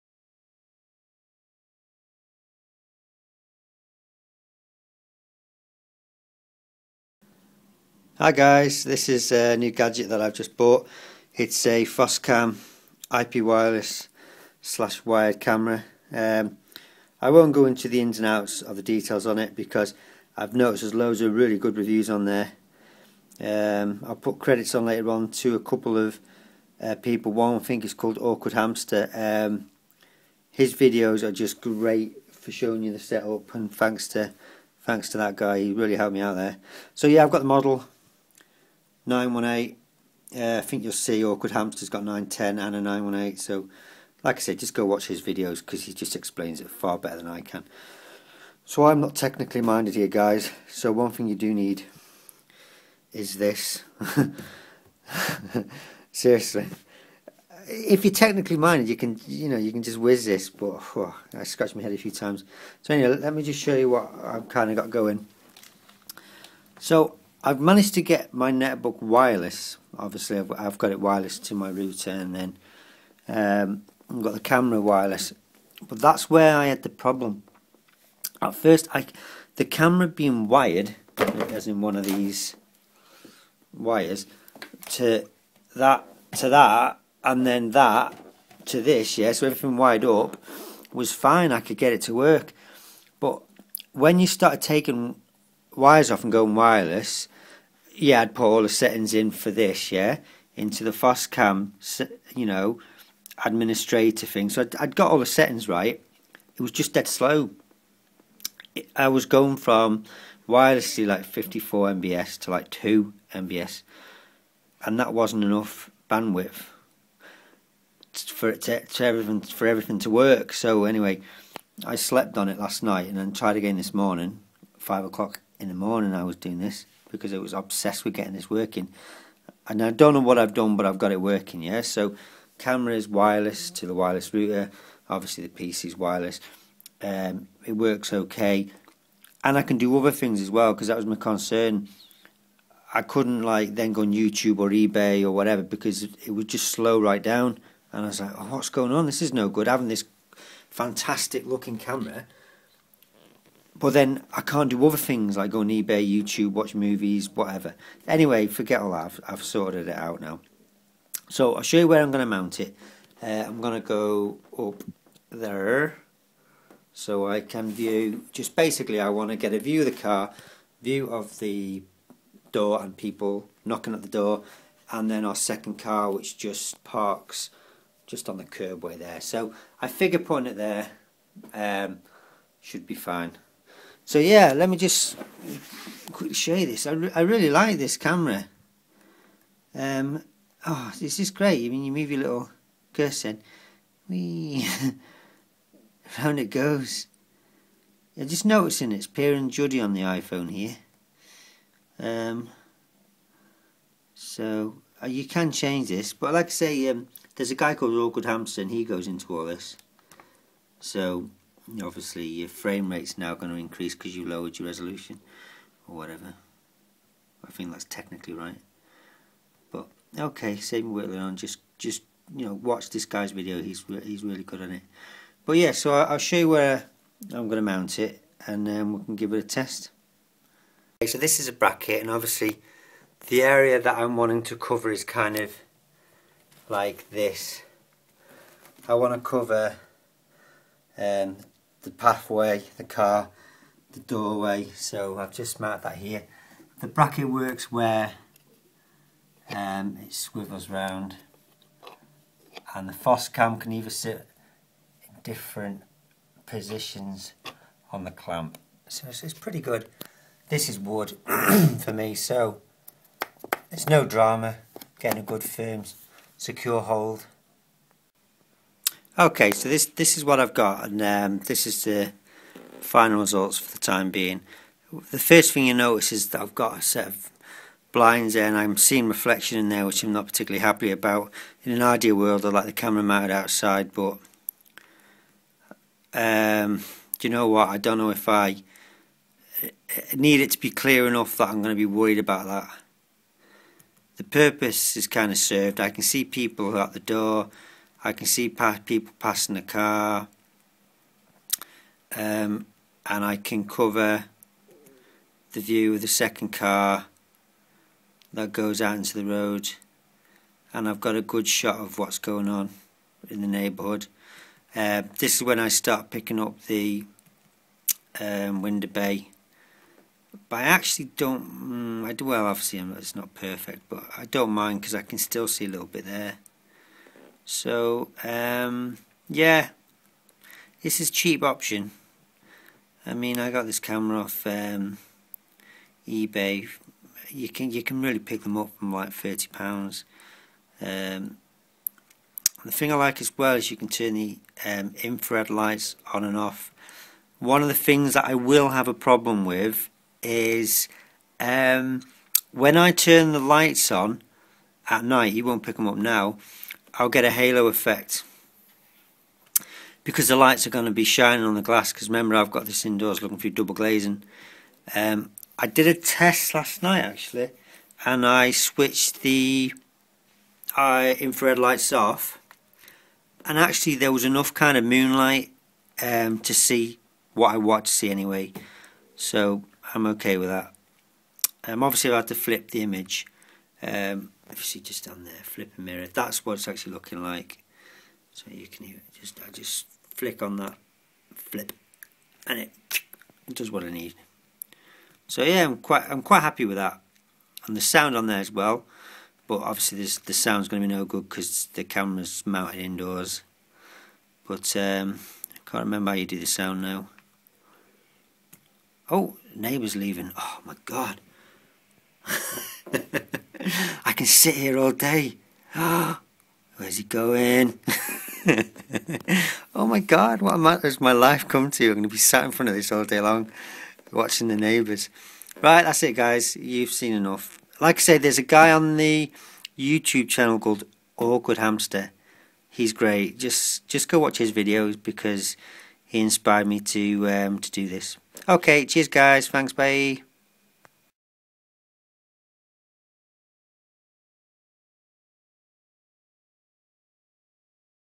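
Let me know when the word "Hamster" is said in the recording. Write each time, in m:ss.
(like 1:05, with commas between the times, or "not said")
0:28, 0:41, 3:28, 7:11.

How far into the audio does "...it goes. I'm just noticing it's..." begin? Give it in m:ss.
3:16.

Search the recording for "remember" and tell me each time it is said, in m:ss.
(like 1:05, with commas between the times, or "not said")
6:02, 6:45.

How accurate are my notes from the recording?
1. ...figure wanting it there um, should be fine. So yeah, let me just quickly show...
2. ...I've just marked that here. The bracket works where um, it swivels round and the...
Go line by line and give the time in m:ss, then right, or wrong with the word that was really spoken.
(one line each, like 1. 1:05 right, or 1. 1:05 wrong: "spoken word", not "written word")
1. 2:59 wrong: "putting", not "wanting"
2. 4:05 right.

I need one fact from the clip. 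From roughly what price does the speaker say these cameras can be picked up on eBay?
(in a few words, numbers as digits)
30 pounds.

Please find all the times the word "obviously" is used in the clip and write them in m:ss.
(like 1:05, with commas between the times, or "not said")
1:09, 2:15, 3:31, 3:52, 5:22, 6:21, 6:39.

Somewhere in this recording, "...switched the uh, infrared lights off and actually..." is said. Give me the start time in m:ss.
6:08.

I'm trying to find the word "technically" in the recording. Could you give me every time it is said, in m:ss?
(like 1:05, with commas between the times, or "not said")
0:49, 0:58, 3:37.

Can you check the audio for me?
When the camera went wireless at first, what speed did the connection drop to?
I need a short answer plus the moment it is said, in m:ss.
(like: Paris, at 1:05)
2 MBS, at 1:52.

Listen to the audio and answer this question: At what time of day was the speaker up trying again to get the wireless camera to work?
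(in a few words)
five o'clock in the morning.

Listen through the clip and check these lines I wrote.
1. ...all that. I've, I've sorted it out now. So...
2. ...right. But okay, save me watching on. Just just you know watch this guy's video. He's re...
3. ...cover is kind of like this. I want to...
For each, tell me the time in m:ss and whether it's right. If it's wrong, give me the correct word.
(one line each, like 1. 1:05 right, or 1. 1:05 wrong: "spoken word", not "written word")
1. 2:38 right
2. 3:38 wrong: "whittling", not "watching"
3. 3:54 right.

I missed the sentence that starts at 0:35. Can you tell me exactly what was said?
He really helped me out there.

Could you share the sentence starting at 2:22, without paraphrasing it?
I couldn't like then go on YouTube or eBay or whatever because it would just slow right down.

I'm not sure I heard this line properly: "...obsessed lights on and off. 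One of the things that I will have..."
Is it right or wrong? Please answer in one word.
wrong.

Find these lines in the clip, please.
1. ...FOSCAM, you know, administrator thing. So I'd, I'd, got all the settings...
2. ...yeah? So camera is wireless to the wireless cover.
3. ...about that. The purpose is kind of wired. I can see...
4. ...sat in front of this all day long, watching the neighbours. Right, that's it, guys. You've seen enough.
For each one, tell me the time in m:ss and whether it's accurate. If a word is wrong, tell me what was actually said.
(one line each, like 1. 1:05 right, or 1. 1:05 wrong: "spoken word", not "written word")
1. 1:40 right
2. 2:11 wrong: "router", not "cover"
3. 4:52 wrong: "served", not "wired"
4. 7:02 right.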